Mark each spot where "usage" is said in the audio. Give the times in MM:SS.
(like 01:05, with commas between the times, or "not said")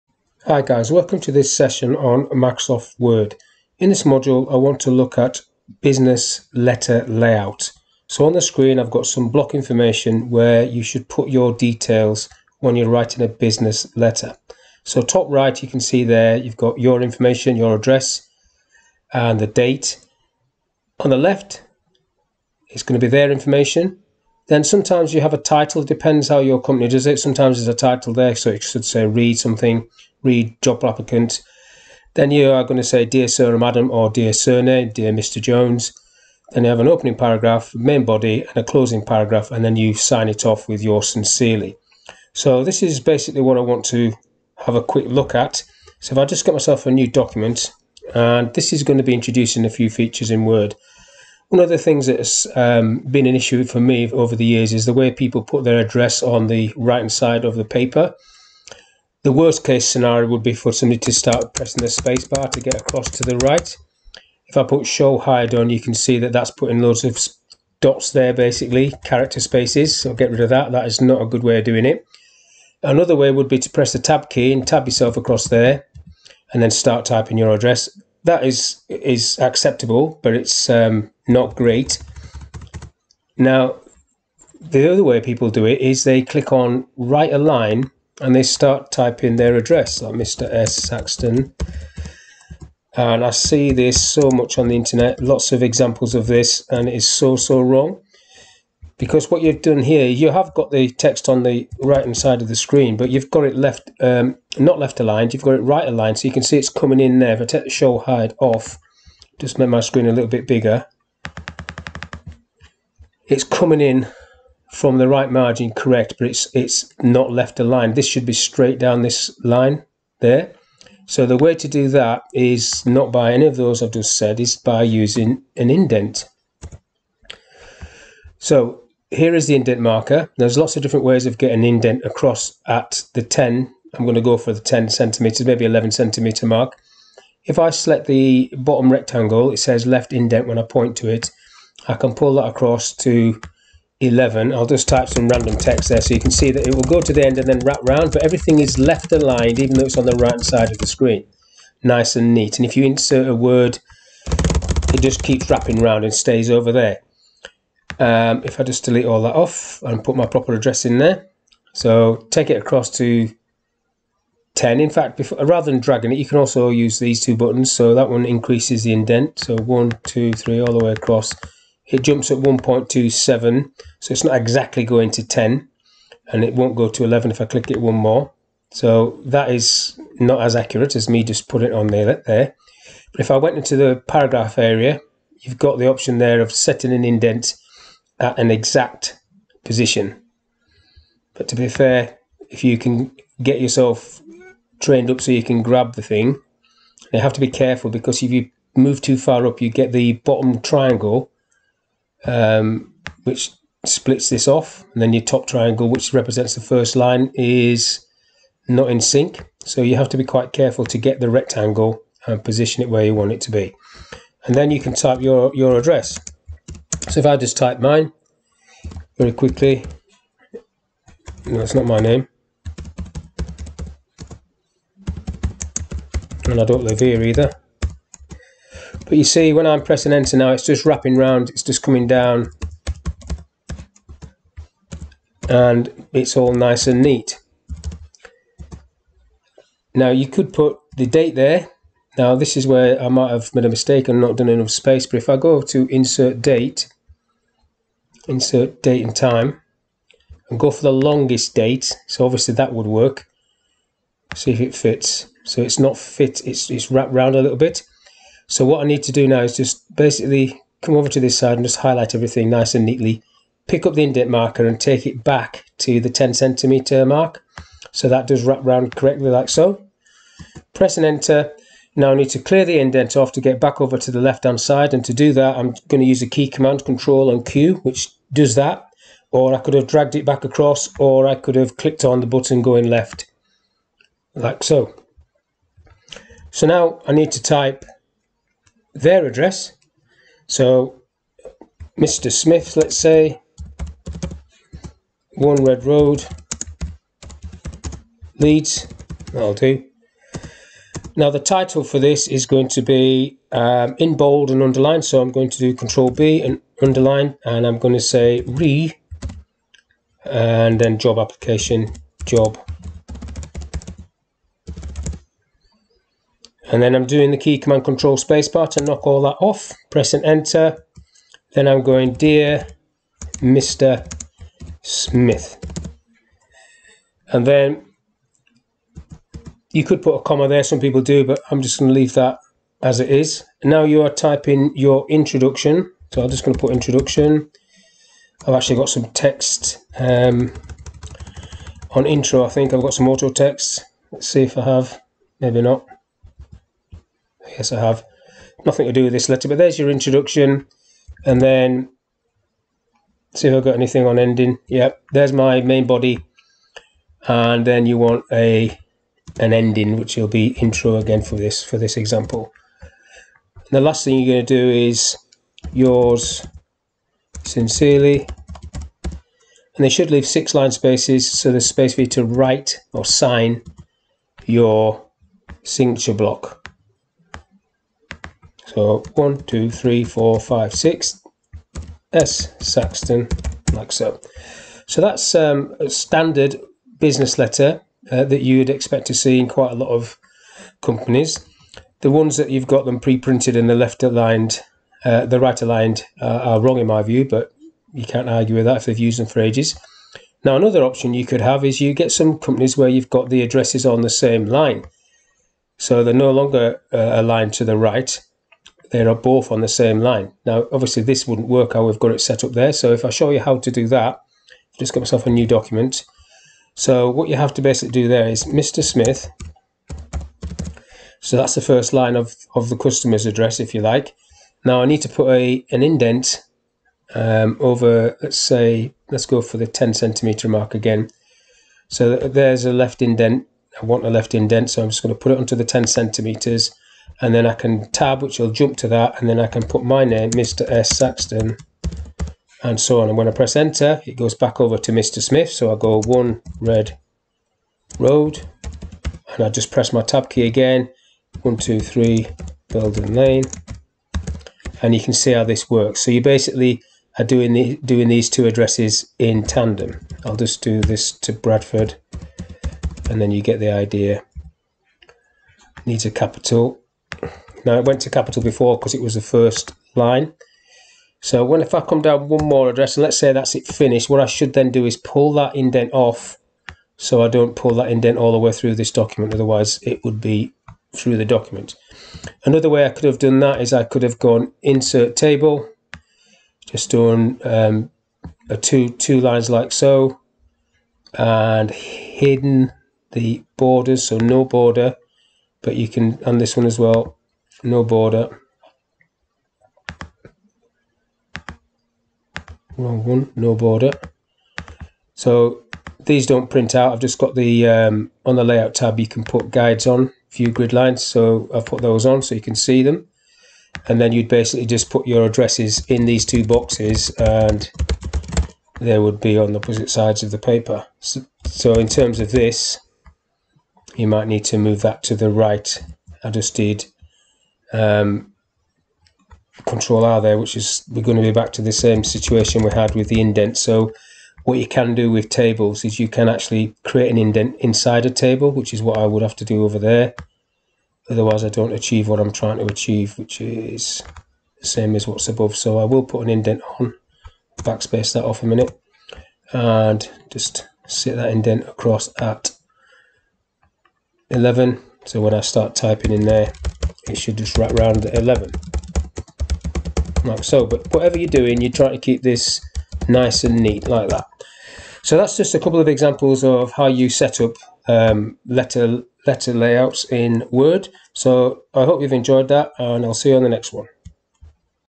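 not said.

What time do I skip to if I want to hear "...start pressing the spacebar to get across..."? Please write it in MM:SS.
01:01.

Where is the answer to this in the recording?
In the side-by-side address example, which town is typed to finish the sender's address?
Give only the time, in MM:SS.
07:41.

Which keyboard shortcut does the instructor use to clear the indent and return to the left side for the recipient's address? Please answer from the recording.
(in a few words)
Control and Q.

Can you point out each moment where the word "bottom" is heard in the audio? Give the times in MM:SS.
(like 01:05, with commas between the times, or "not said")
02:18, 03:20.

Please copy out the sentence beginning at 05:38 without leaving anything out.
I've actually got some text um, on intro, I think.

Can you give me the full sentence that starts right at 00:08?
So on the screen I've got some block information where you should put your details when you're writing a business letter.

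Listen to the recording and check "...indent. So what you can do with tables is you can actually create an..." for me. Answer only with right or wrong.
right.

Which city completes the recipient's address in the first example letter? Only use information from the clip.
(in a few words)
Leeds.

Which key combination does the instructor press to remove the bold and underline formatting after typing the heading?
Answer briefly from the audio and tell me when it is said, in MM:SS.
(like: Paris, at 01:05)
Control spacebar, at 05:17.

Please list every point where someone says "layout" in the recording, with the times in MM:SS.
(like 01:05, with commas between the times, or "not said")
00:07, 08:28, 09:29.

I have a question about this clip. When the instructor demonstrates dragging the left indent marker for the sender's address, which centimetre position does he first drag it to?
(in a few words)
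11.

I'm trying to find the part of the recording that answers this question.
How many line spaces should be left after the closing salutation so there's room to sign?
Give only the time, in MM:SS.
06:10.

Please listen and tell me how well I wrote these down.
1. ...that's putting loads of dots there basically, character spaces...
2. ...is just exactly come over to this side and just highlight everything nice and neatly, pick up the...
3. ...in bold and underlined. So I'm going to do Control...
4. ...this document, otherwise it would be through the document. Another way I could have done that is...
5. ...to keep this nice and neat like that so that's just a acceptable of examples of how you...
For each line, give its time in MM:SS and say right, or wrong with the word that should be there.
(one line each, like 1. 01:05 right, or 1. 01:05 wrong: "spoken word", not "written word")
1. 01:06 right
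2. 04:19 wrong: "basically", not "exactly"
3. 05:03 right
4. 07:58 right
5. 09:21 wrong: "couple", not "acceptable".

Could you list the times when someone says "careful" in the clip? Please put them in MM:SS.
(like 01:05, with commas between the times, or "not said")
03:17, 03:30.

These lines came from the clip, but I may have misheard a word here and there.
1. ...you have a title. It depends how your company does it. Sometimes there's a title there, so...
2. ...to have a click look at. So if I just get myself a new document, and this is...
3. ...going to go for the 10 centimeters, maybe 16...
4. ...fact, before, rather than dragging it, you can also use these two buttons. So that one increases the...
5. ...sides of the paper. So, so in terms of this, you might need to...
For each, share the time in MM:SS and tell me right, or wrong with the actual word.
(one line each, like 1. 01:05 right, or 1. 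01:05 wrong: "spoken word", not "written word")
1. 00:25 right
2. 00:43 wrong: "quick", not "click"
3. 02:14 wrong: "11", not "16"
4. 02:44 right
5. 08:39 right.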